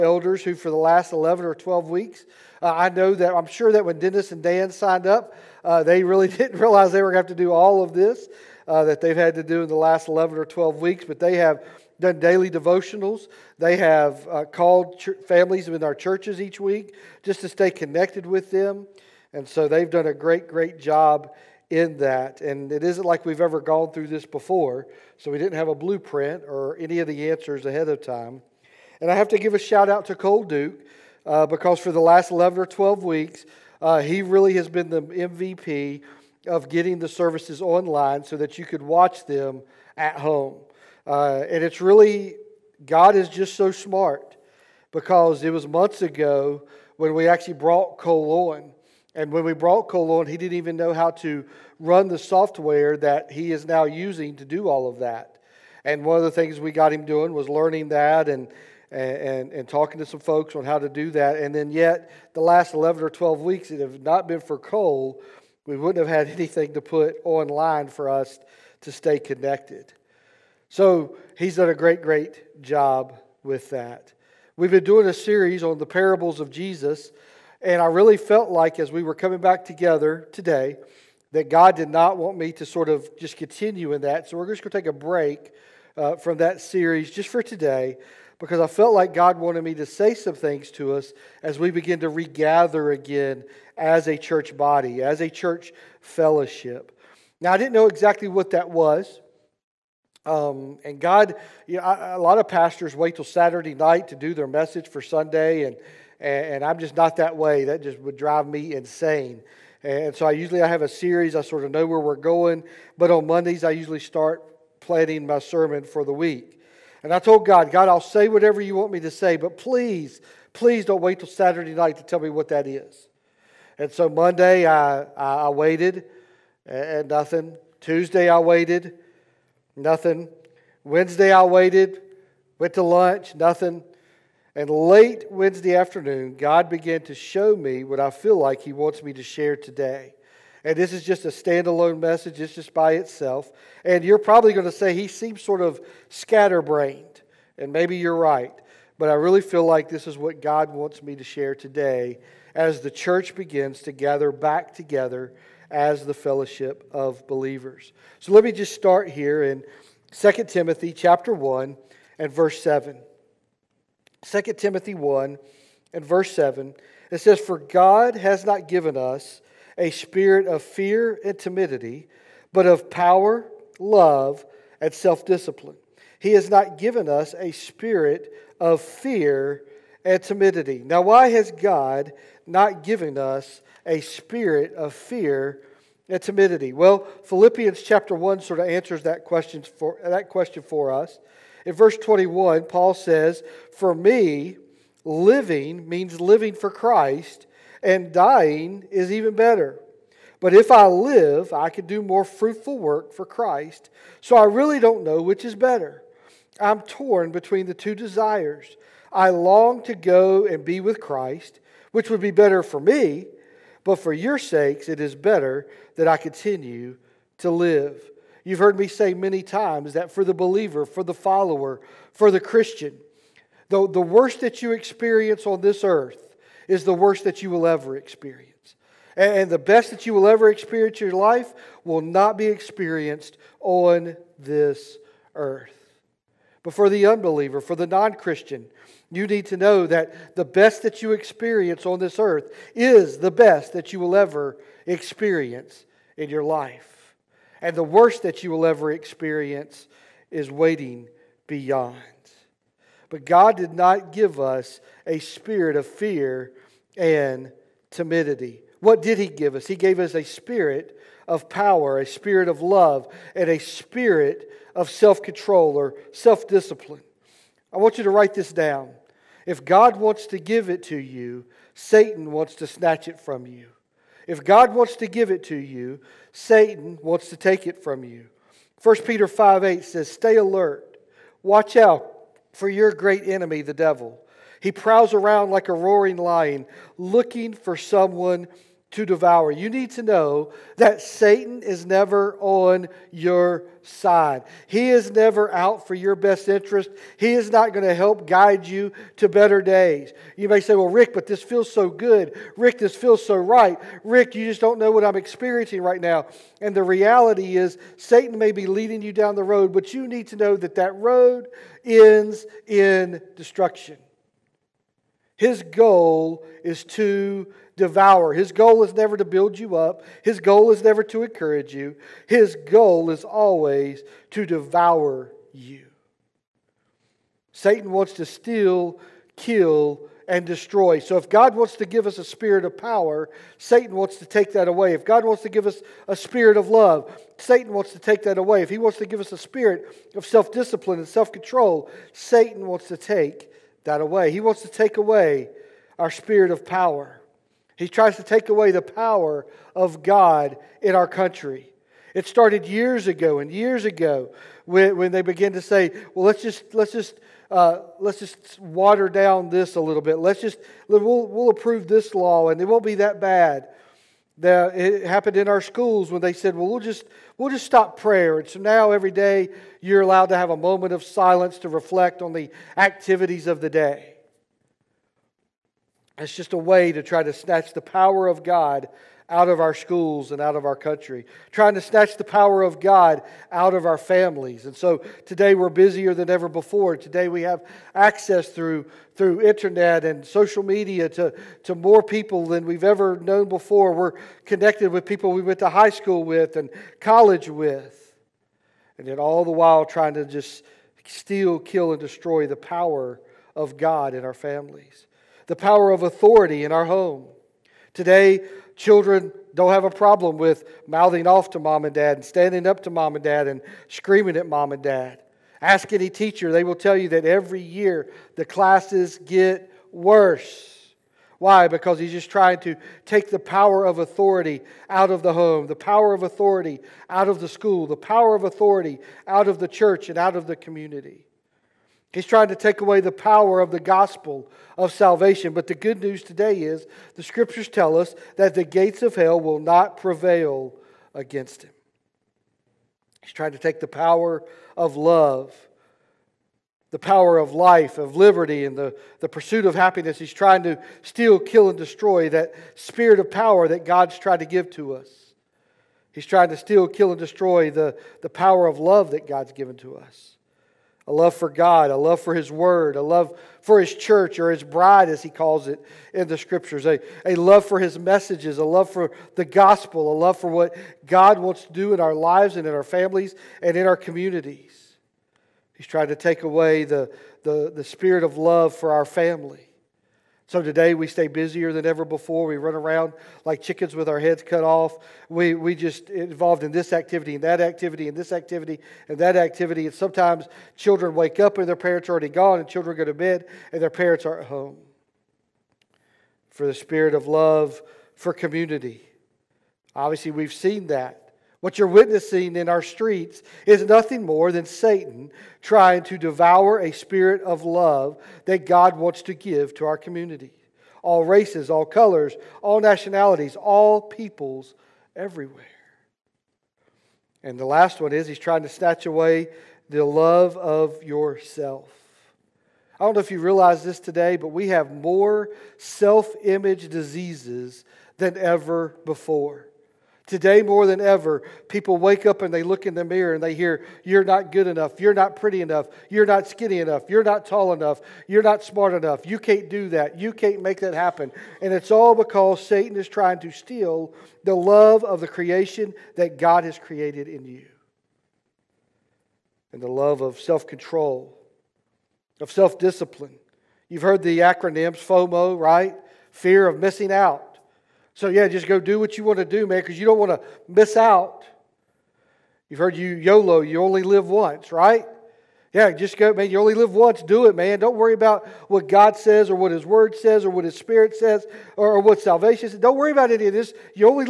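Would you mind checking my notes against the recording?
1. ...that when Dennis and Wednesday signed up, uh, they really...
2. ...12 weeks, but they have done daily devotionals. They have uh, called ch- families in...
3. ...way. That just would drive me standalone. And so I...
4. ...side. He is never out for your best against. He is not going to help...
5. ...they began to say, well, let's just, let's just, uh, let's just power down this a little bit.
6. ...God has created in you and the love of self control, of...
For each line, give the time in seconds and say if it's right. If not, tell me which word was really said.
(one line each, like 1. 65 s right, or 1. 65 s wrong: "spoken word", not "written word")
1. 3 s wrong: "Dan", not "Wednesday"
2. 10 s right
3. 107 s wrong: "insane", not "standalone"
4. 293 s wrong: "interest", not "against"
5. 355 s wrong: "water", not "power"
6. 546 s right.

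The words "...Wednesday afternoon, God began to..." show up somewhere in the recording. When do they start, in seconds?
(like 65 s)
135 s.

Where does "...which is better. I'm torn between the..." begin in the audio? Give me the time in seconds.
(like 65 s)
205 s.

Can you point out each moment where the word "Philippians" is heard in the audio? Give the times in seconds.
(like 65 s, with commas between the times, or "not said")
187 s.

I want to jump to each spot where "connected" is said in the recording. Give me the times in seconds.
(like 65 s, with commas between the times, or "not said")
17 s, 69 s, 394 s.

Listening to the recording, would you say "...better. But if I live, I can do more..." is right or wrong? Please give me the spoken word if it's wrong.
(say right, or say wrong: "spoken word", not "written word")
right.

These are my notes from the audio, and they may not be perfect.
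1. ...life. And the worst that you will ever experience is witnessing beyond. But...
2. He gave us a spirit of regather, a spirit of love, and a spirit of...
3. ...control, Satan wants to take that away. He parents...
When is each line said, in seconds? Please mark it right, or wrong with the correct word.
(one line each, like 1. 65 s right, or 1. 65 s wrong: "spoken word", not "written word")
1. 246 s wrong: "waiting", not "witnessing"
2. 259 s wrong: "power", not "regather"
3. 341 s wrong: "wants", not "parents".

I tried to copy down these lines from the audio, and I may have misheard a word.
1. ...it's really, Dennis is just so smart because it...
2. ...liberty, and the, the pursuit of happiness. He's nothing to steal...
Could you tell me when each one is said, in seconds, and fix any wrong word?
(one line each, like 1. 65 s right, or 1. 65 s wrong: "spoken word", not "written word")
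1. 41 s wrong: "God", not "Dennis"
2. 448 s wrong: "trying", not "nothing".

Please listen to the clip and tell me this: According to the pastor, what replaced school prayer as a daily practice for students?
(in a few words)
moment of silence.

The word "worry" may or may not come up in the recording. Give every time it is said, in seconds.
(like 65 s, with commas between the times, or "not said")
567 s, 572 s.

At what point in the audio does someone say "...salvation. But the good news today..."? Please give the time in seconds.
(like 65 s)
434 s.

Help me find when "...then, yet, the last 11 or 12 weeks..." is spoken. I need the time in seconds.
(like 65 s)
61 s.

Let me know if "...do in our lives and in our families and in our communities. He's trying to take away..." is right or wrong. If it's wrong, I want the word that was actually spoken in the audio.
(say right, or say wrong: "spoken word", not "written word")
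right.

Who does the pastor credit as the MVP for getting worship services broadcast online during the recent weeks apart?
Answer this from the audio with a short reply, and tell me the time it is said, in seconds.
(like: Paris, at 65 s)
Cole Duke, at 30 s.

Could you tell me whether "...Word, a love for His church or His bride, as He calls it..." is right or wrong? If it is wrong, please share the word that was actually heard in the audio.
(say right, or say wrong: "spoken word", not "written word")
right.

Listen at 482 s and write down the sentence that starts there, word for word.
We run around like chickens with our heads cut off.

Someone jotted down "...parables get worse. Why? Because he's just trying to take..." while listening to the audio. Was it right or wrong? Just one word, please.
wrong.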